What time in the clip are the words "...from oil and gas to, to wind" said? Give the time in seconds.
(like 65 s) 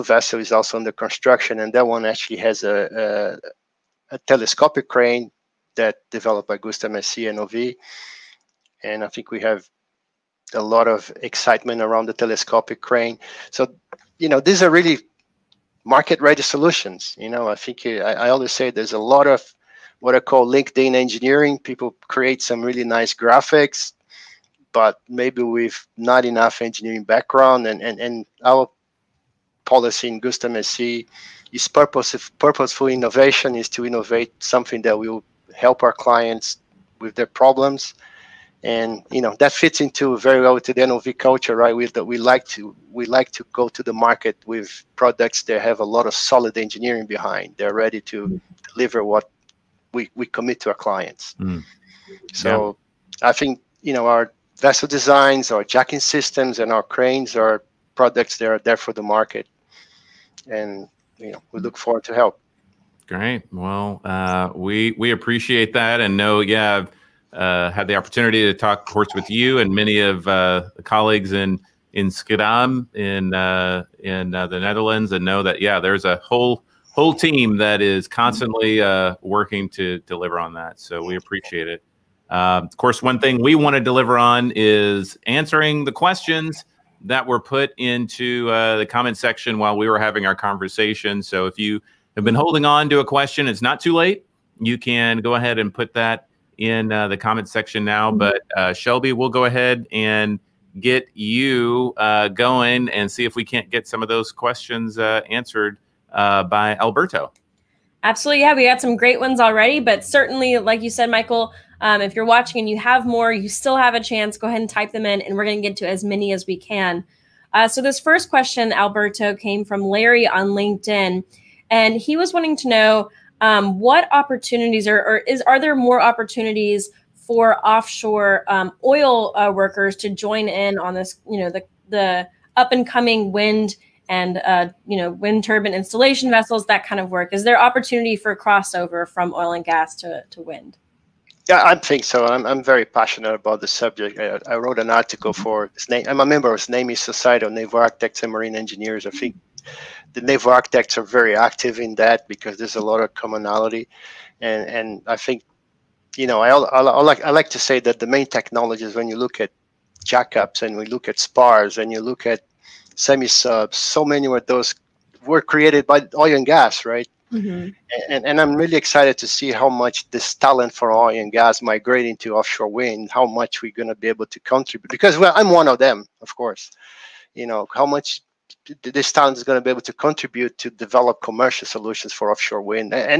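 139 s.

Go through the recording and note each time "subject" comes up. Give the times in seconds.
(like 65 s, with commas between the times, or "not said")
143 s.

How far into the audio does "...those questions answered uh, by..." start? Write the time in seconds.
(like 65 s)
104 s.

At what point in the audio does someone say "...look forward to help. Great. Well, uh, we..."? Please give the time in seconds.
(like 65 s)
61 s.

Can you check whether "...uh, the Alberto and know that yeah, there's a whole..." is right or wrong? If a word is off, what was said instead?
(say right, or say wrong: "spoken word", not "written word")
wrong: "Netherlands", not "Alberto".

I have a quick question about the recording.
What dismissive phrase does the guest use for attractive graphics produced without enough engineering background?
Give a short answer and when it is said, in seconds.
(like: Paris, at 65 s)
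LinkedIn engineering, at 20 s.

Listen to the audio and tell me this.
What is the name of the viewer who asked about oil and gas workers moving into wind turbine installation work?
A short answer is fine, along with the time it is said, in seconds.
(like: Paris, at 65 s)
Larry, at 119 s.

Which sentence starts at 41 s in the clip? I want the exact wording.
With that, we like to we like to go to the market with products that have a lot of solid engineering behind.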